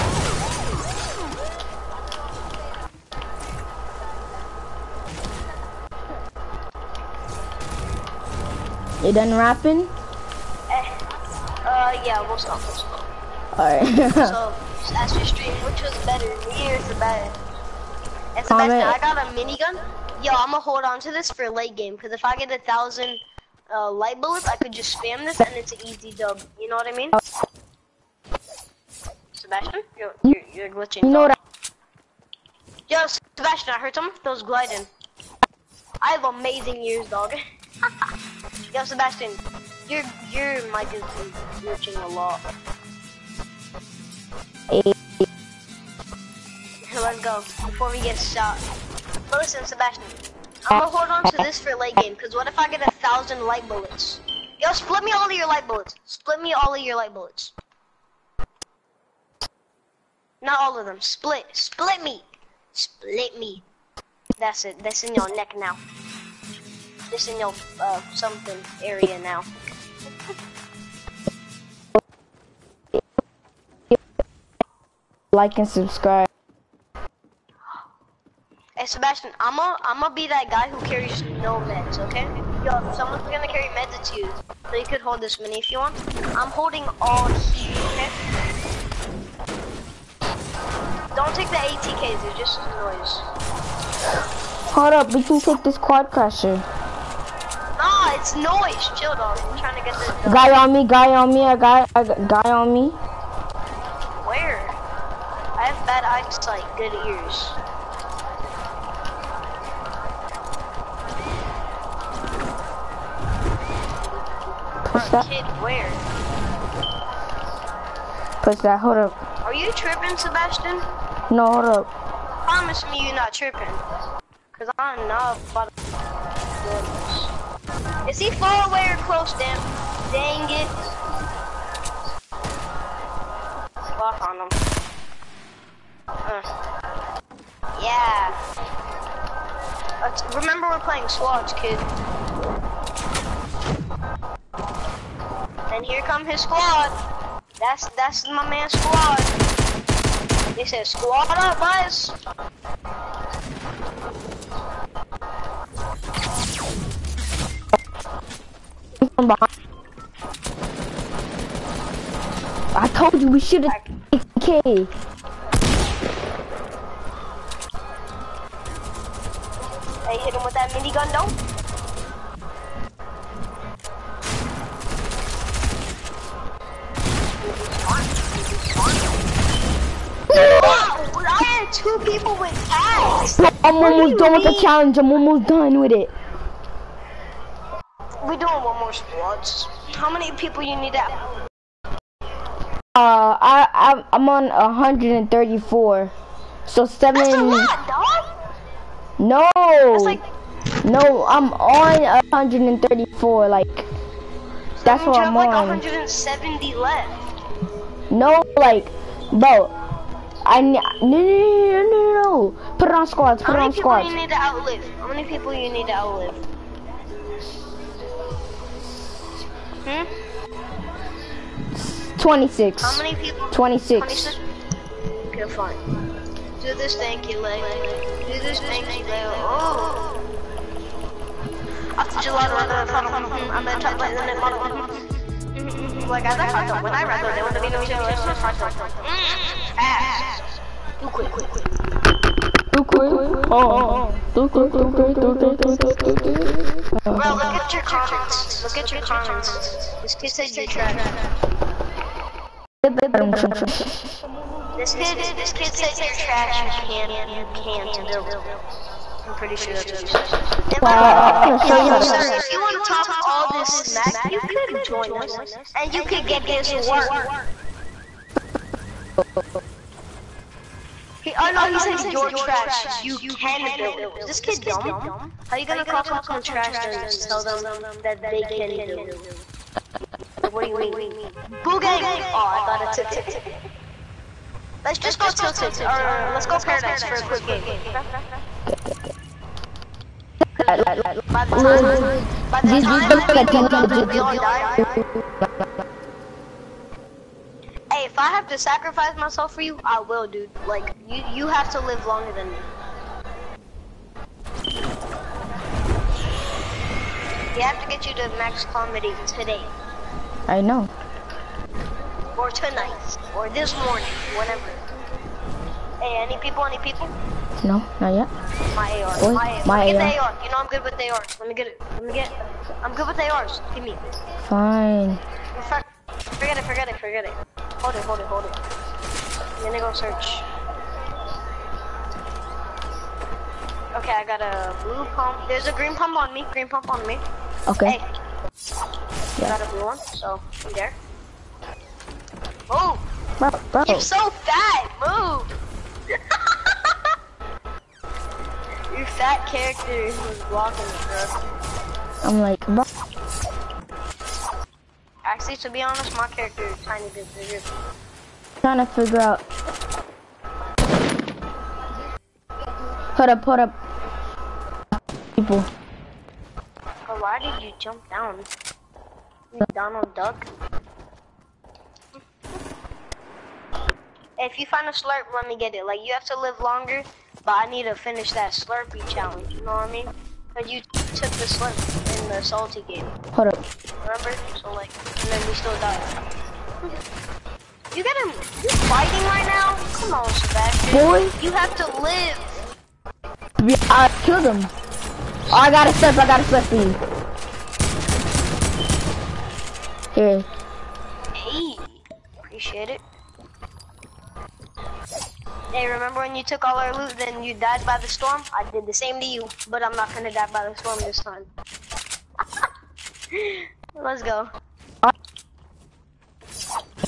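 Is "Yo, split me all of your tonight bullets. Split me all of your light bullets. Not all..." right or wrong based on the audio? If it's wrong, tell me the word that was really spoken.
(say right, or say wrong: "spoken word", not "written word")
wrong: "light", not "tonight".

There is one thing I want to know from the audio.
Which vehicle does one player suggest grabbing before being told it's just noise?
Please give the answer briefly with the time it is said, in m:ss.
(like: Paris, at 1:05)
Quadcrasher, at 1:35.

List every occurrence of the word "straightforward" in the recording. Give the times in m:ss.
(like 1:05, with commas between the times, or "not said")
not said.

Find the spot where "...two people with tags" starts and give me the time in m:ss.
3:01.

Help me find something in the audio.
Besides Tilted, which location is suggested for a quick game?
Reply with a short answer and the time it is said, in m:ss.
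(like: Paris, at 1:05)
Paradise, at 4:46.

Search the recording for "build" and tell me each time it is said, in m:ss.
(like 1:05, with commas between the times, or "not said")
4:18, 4:33, 4:38.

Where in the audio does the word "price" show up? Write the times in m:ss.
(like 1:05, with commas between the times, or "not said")
not said.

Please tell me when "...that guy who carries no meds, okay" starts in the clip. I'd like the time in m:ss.
1:20.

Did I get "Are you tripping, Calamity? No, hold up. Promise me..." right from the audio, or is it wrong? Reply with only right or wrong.
wrong.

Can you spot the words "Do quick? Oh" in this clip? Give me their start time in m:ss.
4:02.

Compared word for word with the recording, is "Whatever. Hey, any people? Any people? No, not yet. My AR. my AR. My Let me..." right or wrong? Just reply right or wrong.
right.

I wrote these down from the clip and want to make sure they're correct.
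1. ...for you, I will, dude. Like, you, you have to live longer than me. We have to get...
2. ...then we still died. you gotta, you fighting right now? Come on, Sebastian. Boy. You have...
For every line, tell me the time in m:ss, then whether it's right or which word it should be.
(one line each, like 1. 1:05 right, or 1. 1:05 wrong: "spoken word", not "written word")
1. 4:59 right
2. 6:25 right.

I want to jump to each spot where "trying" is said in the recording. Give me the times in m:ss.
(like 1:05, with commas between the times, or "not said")
1:39, 5:58.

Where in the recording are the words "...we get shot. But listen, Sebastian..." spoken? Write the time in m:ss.
0:47.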